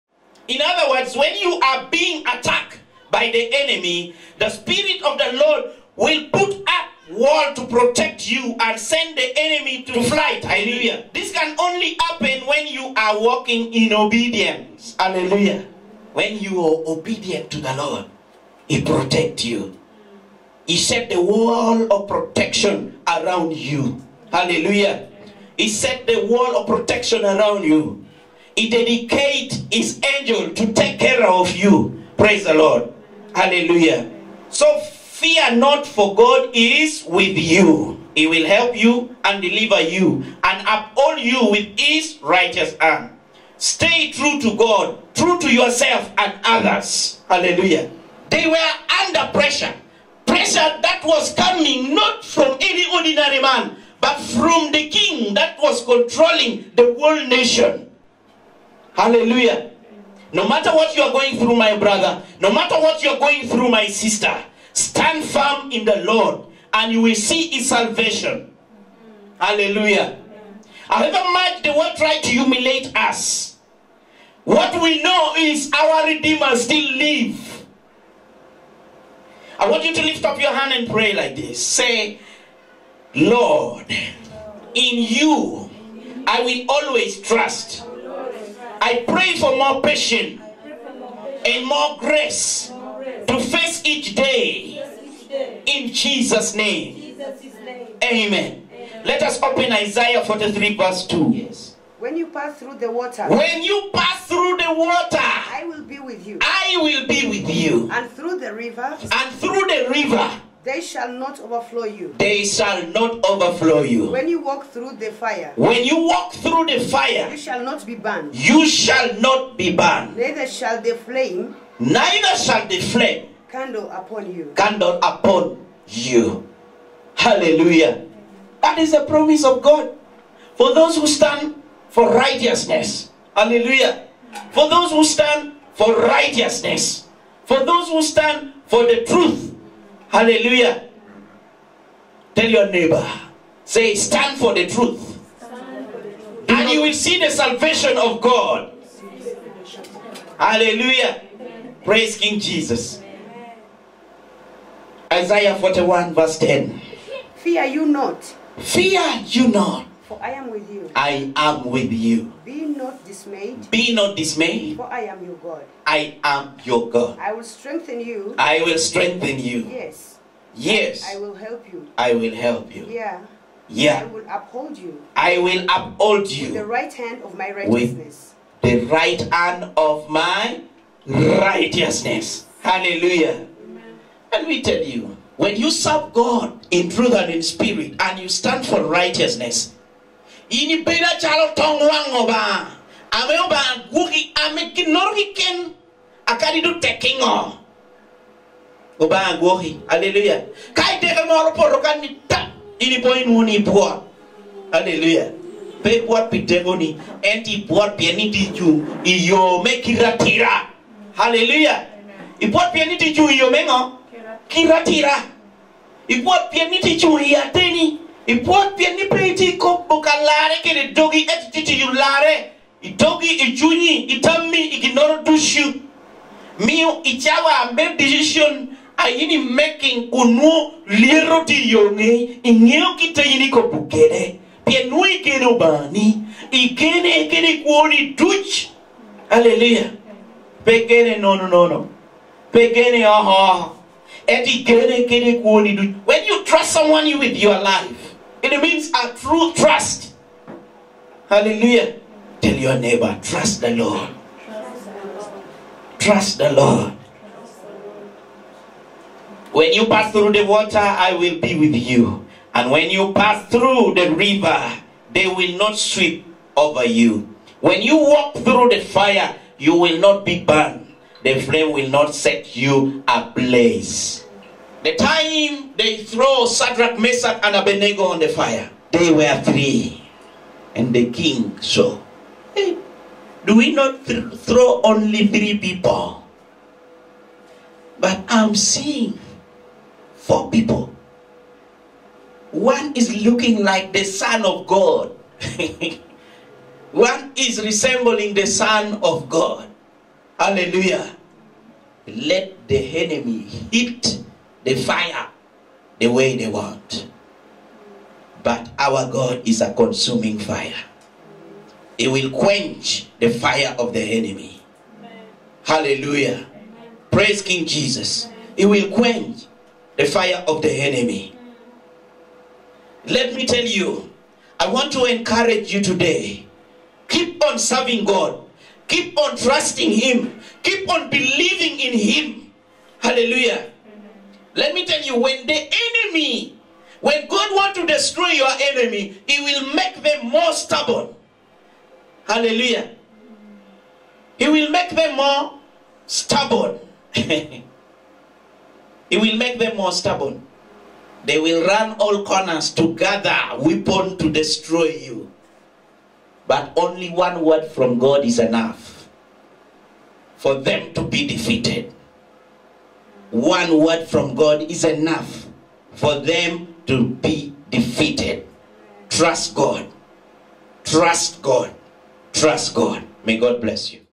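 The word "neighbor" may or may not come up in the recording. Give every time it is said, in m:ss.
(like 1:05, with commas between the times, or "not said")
2:22, 4:12.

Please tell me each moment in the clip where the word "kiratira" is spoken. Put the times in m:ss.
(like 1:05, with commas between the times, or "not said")
3:29, 3:34.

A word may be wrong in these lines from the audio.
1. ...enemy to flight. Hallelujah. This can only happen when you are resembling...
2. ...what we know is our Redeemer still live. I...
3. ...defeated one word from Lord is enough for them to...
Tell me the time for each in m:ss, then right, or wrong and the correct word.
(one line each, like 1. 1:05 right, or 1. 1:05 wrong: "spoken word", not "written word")
1. 0:09 wrong: "walking", not "resembling"
2. 1:14 right
3. 6:01 wrong: "God", not "Lord".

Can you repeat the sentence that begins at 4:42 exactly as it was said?
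Hey, do we not th throw only three people?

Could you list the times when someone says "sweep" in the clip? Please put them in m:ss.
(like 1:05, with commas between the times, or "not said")
4:25.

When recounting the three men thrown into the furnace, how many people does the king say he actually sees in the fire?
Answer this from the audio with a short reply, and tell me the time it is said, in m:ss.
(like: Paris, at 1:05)
4, at 4:50.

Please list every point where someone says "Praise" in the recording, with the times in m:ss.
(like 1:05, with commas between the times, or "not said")
0:32, 2:31, 5:17.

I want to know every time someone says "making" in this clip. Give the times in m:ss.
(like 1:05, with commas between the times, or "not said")
3:49.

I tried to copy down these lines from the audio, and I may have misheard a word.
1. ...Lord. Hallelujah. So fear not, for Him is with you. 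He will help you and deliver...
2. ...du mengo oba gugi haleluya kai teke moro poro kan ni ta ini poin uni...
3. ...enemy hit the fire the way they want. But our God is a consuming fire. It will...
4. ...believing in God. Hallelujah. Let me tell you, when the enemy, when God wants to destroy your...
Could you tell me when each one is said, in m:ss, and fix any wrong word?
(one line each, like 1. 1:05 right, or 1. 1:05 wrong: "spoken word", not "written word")
1. 0:32 wrong: "God", not "Him"
2. 3:16 wrong: "tekingo", not "mengo"
3. 5:02 right
4. 5:31 wrong: "Him", not "God".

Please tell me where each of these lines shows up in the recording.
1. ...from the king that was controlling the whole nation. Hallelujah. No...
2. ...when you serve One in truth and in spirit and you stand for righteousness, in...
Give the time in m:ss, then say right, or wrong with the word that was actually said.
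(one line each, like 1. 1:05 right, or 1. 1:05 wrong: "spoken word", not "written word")
1. 0:54 right
2. 3:05 wrong: "God", not "One".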